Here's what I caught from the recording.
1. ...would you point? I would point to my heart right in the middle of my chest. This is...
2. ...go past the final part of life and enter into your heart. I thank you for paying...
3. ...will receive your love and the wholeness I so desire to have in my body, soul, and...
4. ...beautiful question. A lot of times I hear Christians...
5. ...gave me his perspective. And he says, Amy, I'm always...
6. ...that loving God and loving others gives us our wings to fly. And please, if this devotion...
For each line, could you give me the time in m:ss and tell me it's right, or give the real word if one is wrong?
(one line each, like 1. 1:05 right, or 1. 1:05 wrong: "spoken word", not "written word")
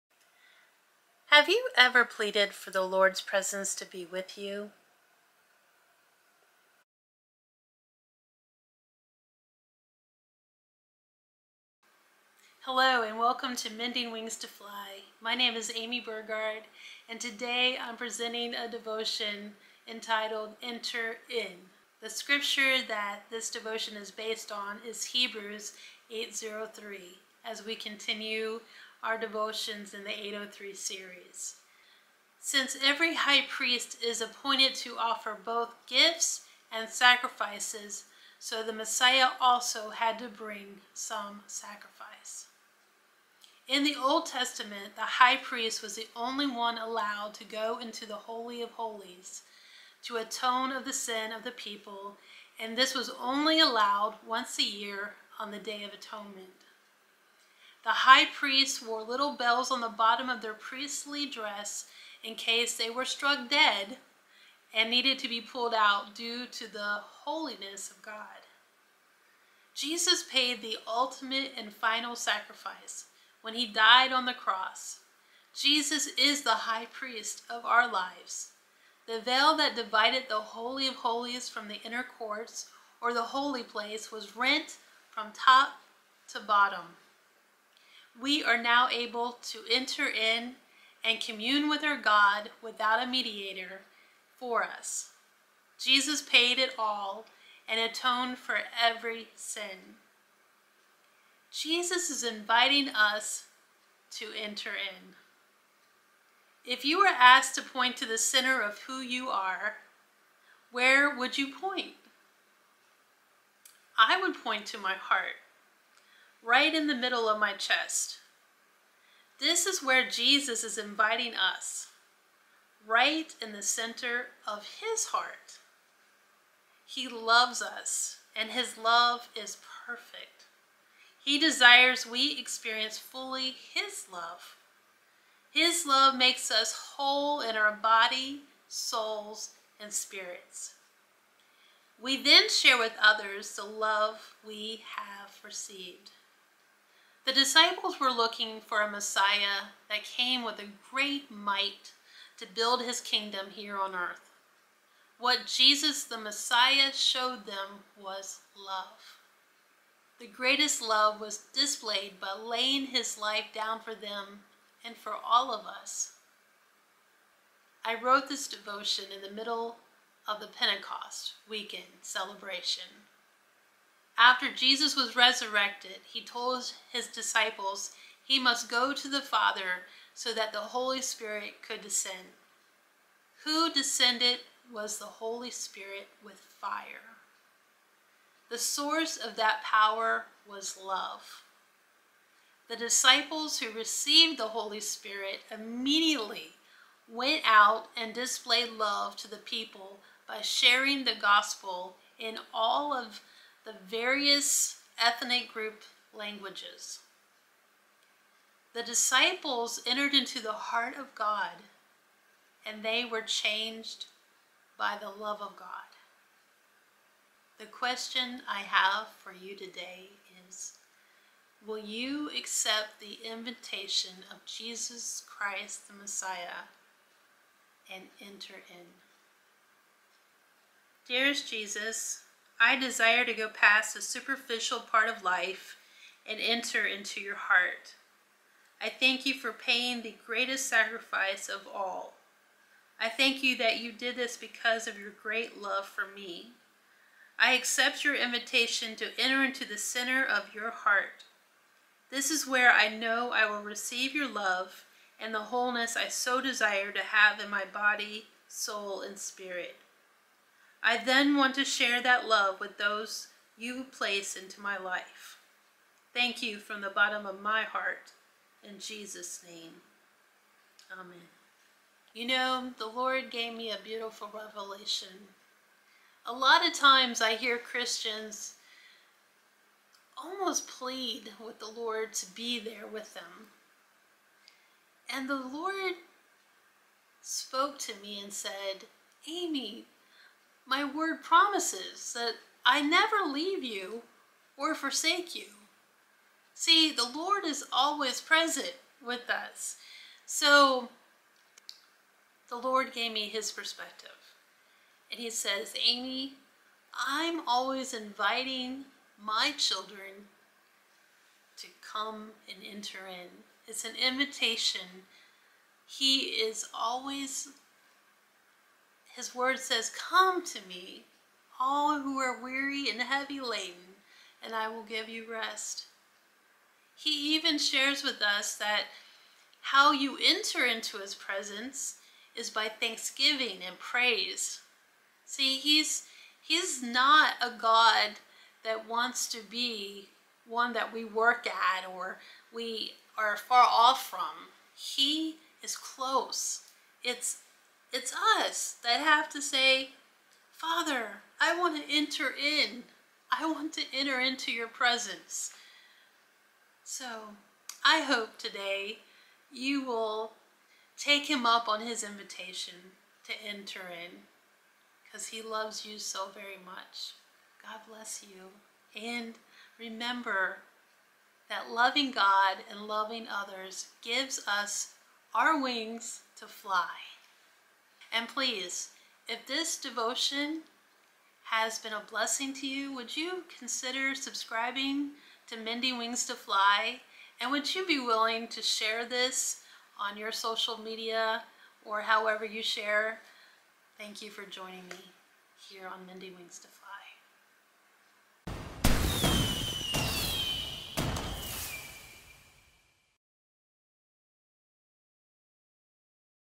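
1. 1:51 right
2. 3:53 wrong: "superficial", not "final"
3. 4:13 right
4. 4:33 wrong: "revelation", not "question"
5. 5:02 right
6. 6:11 right.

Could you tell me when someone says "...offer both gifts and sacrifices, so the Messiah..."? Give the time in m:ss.
0:34.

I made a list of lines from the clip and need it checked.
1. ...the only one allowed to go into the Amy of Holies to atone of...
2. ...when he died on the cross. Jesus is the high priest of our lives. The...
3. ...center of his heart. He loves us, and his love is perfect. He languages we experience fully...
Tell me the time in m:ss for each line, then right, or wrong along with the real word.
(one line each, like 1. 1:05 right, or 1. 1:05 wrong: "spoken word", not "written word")
1. 0:45 wrong: "Holy", not "Amy"
2. 1:13 right
3. 2:03 wrong: "desires", not "languages".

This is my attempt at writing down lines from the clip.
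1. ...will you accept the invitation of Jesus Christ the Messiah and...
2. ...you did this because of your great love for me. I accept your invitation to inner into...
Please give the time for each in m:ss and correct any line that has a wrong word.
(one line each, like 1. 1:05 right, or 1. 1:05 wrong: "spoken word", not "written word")
1. 3:41 right
2. 4:03 wrong: "enter", not "inner".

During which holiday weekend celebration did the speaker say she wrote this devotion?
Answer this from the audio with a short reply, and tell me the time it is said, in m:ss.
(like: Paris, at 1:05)
Pentecost, at 2:50.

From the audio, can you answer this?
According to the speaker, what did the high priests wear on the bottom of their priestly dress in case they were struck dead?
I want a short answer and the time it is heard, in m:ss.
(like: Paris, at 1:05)
Little bells, at 0:59.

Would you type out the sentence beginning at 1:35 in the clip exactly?
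Jesus paid it all and atoned for every sin.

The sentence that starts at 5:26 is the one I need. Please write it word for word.
He even shares with us that how you enter into his presence is by thanksgiving and praise.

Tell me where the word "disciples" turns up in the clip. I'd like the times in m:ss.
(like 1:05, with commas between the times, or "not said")
2:27, 2:57, 3:12, 3:28.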